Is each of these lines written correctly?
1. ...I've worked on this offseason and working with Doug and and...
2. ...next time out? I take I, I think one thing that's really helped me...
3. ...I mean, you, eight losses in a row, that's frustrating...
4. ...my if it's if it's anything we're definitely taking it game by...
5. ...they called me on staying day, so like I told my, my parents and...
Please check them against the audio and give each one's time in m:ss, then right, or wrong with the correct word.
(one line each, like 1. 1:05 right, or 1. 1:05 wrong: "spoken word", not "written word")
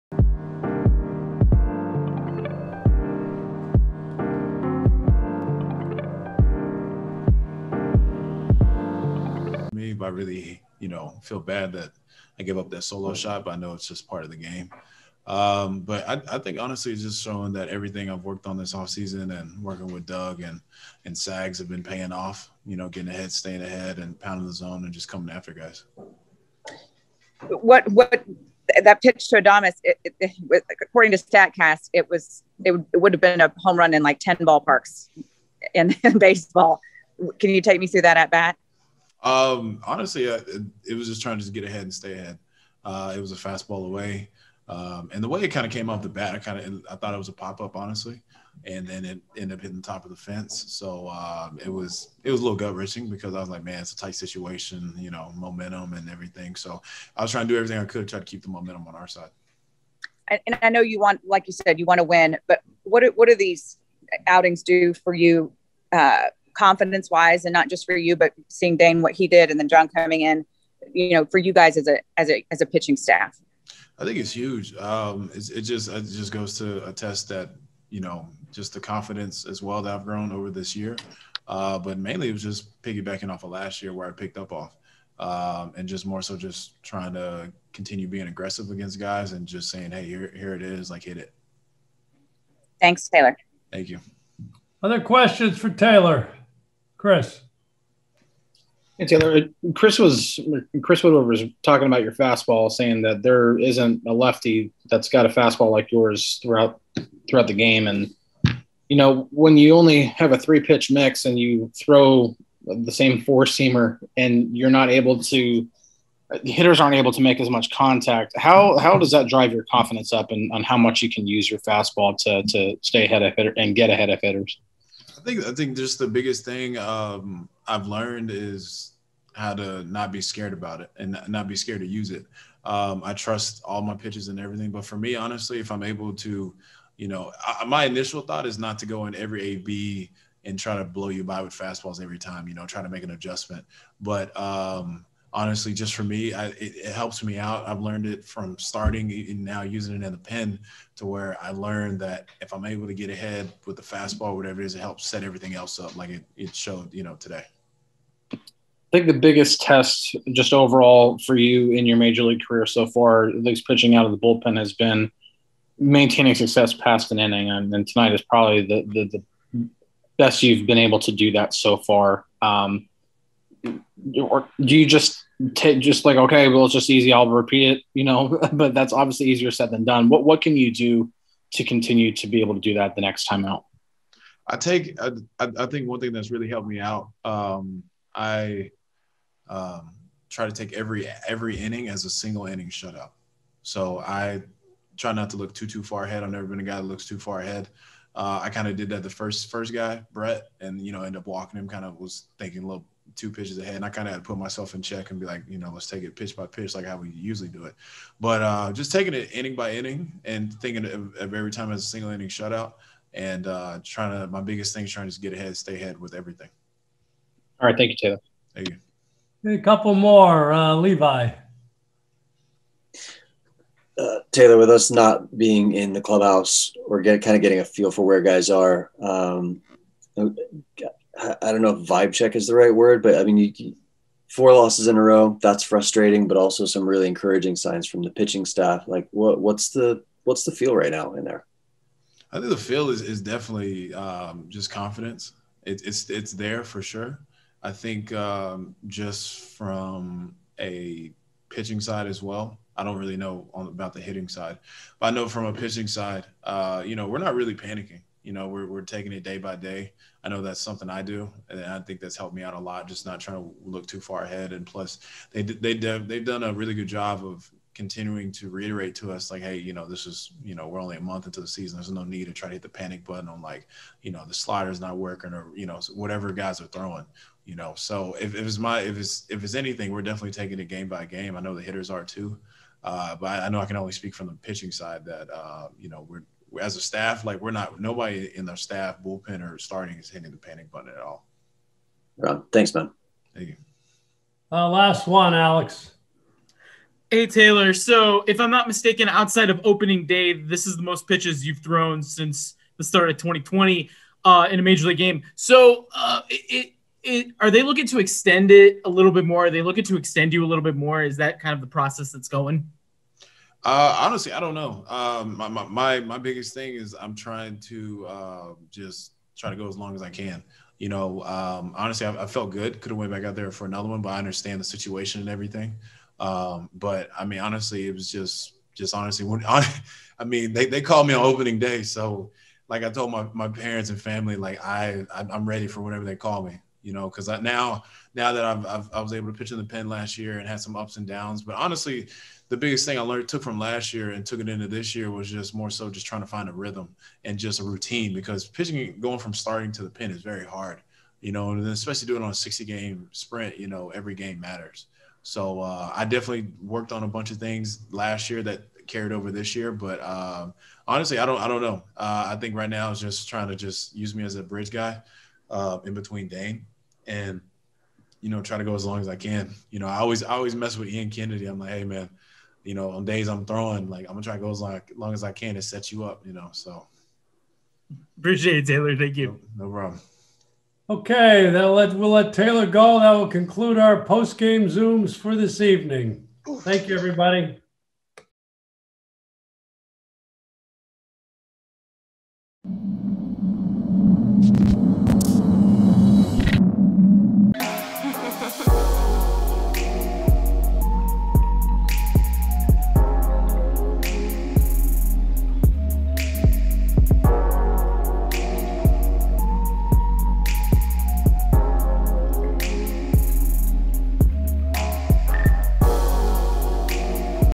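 1. 0:18 right
2. 3:03 right
3. 3:53 wrong: "four", not "eight"
4. 4:38 right
5. 5:30 wrong: "opening", not "staying".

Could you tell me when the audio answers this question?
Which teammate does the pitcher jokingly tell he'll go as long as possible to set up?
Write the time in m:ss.
6:10.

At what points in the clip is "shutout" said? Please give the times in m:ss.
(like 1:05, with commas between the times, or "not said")
3:12, 3:32.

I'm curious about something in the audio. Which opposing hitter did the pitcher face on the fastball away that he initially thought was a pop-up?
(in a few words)
Adames.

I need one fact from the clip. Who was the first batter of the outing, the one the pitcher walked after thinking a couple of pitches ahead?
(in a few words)
Brett.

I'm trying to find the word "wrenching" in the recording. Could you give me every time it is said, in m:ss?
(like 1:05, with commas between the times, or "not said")
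0:52.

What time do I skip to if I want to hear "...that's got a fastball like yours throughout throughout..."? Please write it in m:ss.
1:44.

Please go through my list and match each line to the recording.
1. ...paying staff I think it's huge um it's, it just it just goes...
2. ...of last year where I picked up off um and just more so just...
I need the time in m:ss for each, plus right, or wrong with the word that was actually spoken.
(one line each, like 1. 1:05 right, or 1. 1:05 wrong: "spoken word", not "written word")
1. 1:12 wrong: "pitching", not "paying"
2. 1:23 right.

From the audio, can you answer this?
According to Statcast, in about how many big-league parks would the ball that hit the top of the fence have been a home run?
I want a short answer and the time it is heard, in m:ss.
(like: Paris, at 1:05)
10, at 0:34.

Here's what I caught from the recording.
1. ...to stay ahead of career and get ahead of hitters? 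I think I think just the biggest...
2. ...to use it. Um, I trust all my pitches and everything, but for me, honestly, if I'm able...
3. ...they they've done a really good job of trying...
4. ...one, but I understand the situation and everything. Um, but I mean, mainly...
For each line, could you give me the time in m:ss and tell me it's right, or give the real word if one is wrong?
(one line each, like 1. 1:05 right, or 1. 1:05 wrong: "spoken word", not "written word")
1. 2:02 wrong: "hitter", not "career"
2. 2:11 right
3. 4:25 wrong: "continuing", not "trying"
4. 5:23 wrong: "honestly", not "mainly".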